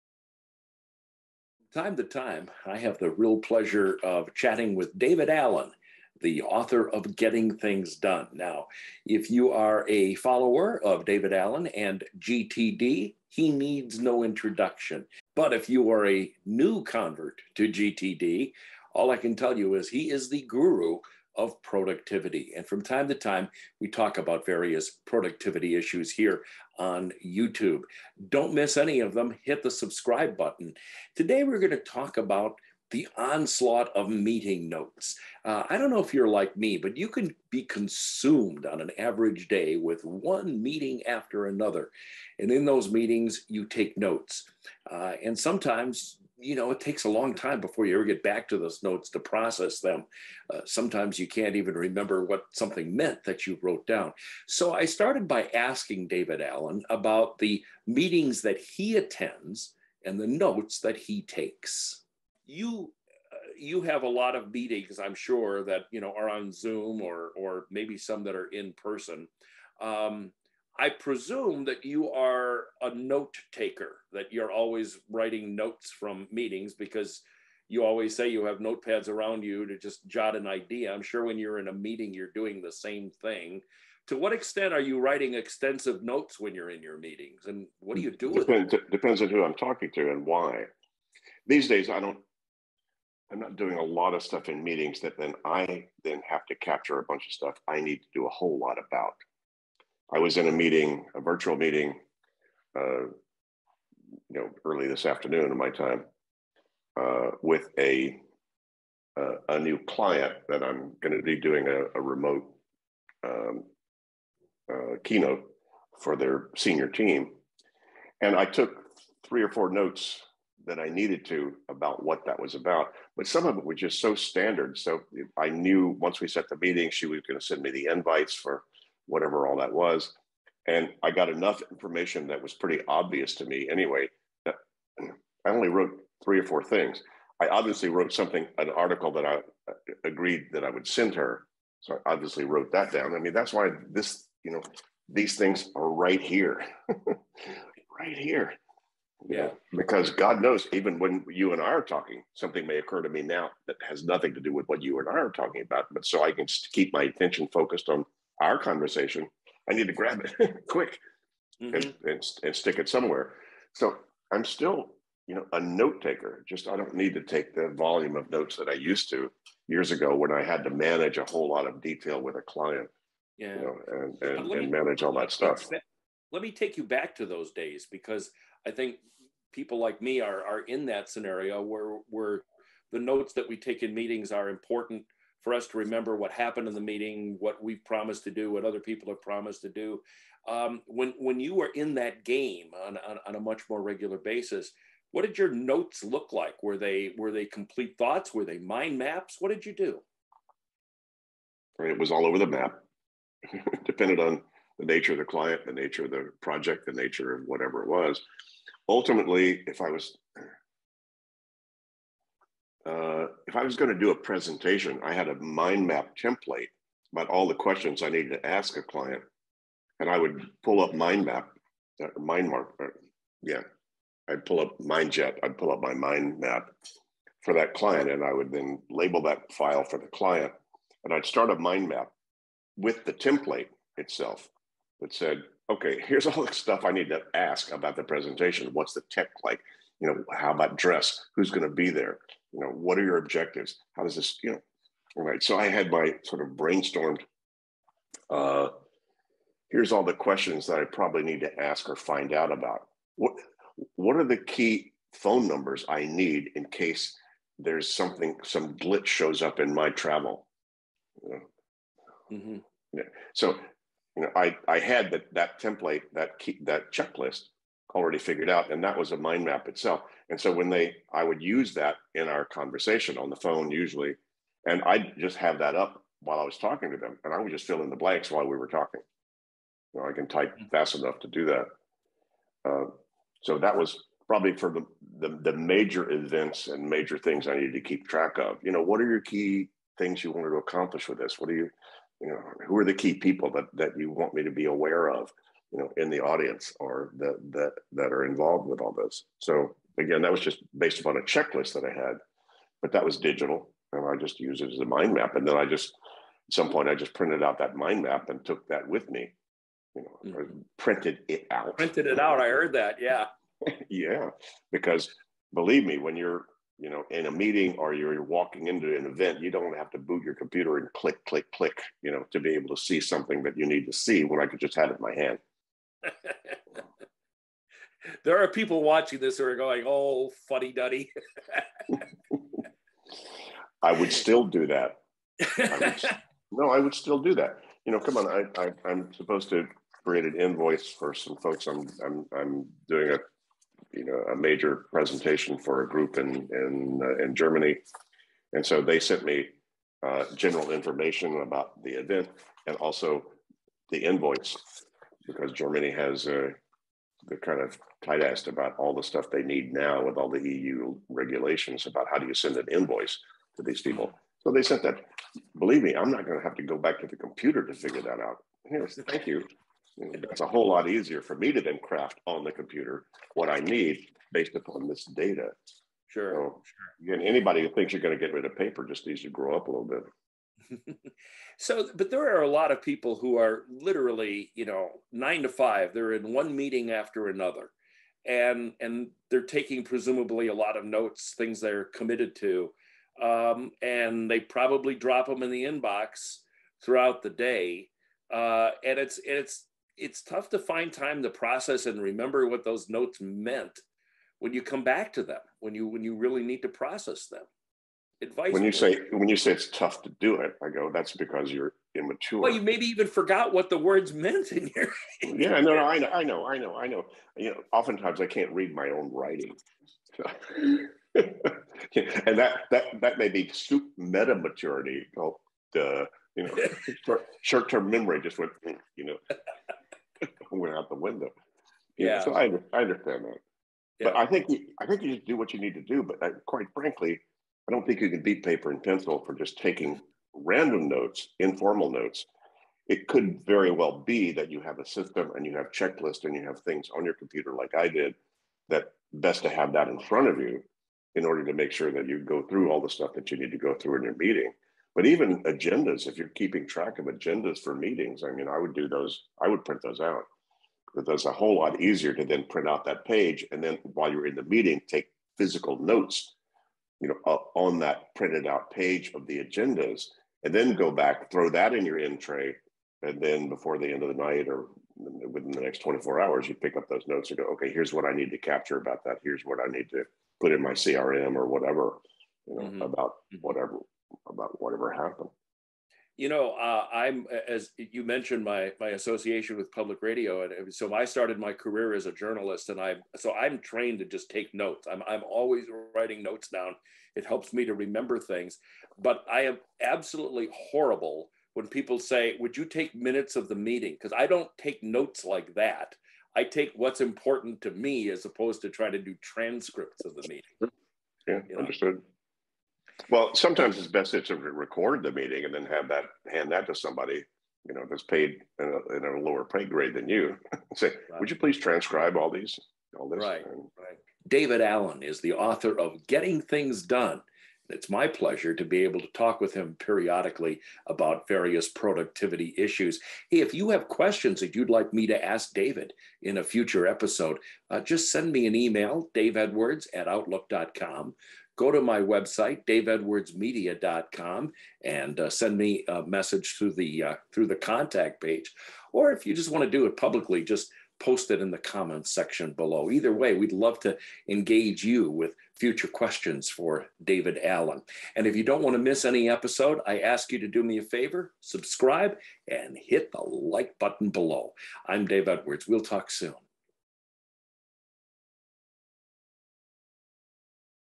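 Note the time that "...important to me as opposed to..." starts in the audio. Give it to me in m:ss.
8:27.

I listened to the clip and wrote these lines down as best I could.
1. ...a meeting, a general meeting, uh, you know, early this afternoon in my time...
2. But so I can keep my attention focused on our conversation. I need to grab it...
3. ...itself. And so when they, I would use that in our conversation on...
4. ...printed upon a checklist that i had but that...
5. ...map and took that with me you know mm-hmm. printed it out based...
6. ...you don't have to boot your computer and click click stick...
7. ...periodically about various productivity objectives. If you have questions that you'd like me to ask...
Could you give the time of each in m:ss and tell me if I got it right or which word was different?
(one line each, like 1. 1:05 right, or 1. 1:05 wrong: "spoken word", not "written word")
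1. 1:40 wrong: "virtual", not "general"
2. 2:35 right
3. 4:29 right
4. 5:00 wrong: "based", not "printed"
5. 5:08 wrong: "printed", not "based"
6. 5:19 wrong: "click", not "stick"
7. 8:49 wrong: "issues", not "objectives".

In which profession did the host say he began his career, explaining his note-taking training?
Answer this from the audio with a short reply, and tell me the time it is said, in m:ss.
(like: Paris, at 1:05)
Journalist, at 8:12.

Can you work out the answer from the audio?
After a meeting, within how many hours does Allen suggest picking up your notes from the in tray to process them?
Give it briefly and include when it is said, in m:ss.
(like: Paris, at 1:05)
24 hours, at 7:55.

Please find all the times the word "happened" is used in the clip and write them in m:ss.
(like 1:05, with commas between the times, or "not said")
3:06, 8:04.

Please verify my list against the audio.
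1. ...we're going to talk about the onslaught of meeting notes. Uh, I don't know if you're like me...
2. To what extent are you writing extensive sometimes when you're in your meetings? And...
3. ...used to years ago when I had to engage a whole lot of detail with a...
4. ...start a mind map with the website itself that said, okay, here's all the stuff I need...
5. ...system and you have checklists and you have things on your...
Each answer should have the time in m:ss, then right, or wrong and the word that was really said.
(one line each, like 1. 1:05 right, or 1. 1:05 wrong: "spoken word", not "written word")
1. 0:31 right
2. 1:24 wrong: "notes", not "sometimes"
3. 2:48 wrong: "manage", not "engage"
4. 3:51 wrong: "template", not "website"
5. 7:24 right.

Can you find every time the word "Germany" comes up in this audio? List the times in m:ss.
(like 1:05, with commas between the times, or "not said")
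5:47, 5:55.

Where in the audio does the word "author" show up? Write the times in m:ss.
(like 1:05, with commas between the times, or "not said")
0:06, 8:45.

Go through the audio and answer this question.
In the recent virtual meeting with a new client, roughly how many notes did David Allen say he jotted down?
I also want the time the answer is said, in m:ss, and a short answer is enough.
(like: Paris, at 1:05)
3 or 4, at 1:59.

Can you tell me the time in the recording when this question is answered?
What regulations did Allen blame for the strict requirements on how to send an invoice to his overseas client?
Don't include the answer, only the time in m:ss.
6:00.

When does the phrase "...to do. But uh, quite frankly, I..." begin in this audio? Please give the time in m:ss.
7:15.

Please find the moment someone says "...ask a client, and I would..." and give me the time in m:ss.
3:38.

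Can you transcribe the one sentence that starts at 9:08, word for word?
Or if you just want to do it publicly, just post it in the comments section below.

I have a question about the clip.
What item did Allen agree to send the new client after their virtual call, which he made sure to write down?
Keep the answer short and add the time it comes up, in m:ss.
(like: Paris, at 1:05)
An article, at 2:18.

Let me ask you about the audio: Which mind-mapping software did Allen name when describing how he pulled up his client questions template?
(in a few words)
MindJet.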